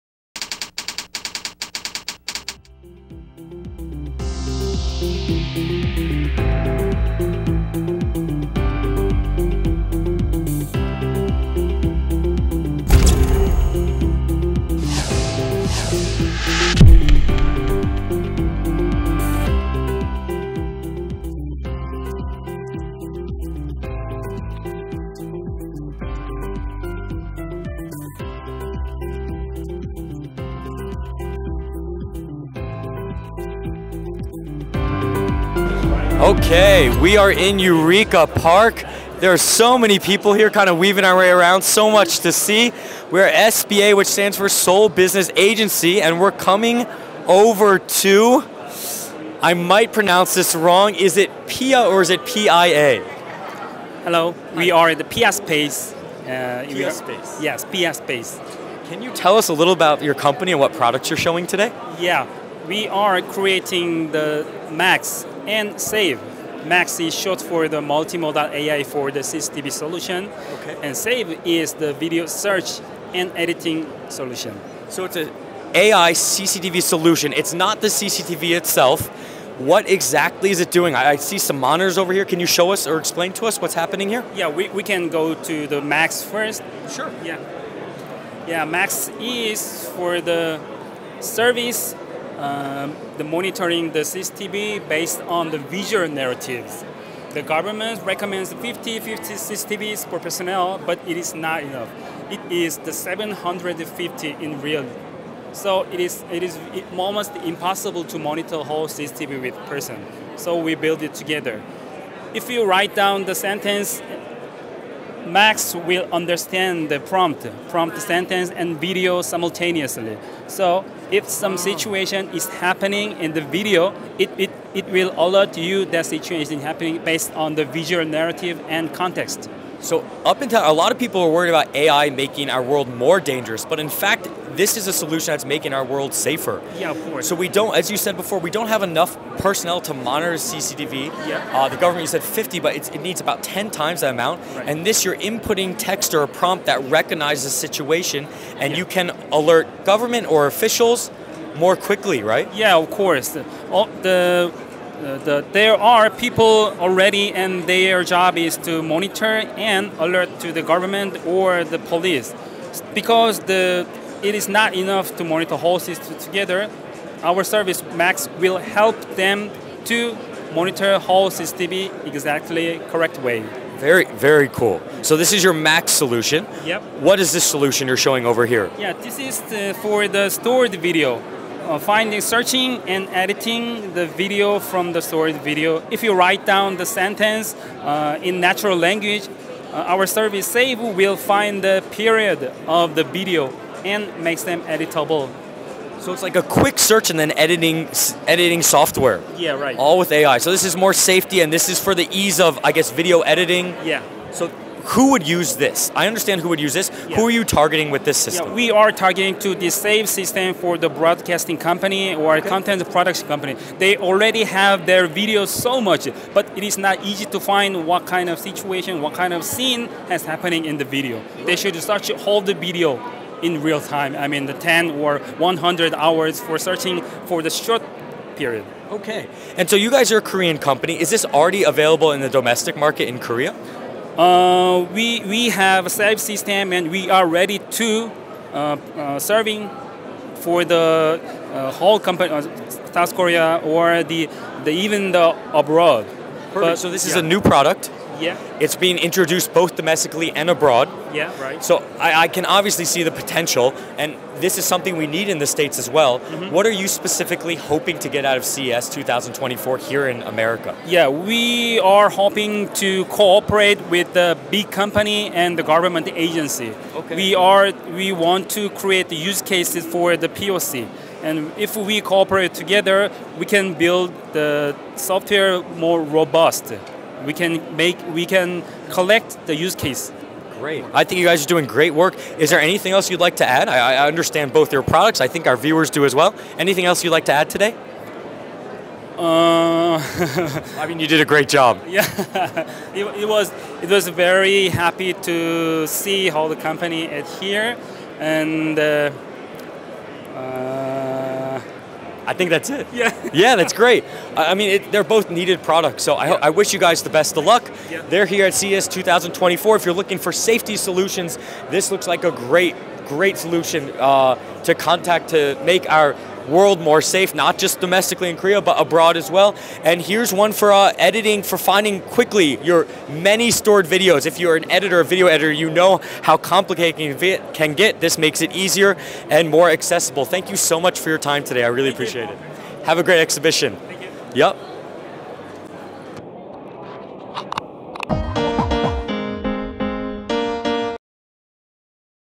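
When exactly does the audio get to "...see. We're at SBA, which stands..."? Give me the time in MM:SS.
00:42.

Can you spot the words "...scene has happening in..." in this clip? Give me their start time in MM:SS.
03:39.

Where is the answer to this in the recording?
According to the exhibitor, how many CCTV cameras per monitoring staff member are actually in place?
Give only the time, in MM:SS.
01:42.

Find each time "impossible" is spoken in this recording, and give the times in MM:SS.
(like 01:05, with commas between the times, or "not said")
01:47.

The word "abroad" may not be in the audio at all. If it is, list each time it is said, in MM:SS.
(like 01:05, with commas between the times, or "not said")
04:05, 04:10, 05:18.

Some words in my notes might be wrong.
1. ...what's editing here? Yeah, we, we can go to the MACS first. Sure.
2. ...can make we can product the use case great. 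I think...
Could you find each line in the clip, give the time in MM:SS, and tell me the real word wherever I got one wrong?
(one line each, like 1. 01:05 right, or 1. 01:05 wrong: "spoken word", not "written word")
1. 01:23 wrong: "happening", not "editing"
2. 04:37 wrong: "collect", not "product".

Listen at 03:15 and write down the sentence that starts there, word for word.
So it's like a quick search and then editing editing software.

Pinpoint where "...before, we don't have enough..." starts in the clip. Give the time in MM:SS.
02:18.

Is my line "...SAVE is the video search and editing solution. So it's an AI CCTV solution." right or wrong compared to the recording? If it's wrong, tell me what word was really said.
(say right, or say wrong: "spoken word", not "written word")
right.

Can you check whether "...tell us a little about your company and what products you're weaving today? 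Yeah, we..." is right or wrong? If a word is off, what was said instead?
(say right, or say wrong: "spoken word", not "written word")
wrong: "showing", not "weaving".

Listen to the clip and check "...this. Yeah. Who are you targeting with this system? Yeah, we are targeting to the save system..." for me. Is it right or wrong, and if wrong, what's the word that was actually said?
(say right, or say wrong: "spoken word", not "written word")
right.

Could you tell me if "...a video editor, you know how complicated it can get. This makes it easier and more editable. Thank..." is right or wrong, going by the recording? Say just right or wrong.
wrong.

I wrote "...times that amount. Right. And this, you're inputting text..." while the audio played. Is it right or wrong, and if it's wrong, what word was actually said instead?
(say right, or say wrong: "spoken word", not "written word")
right.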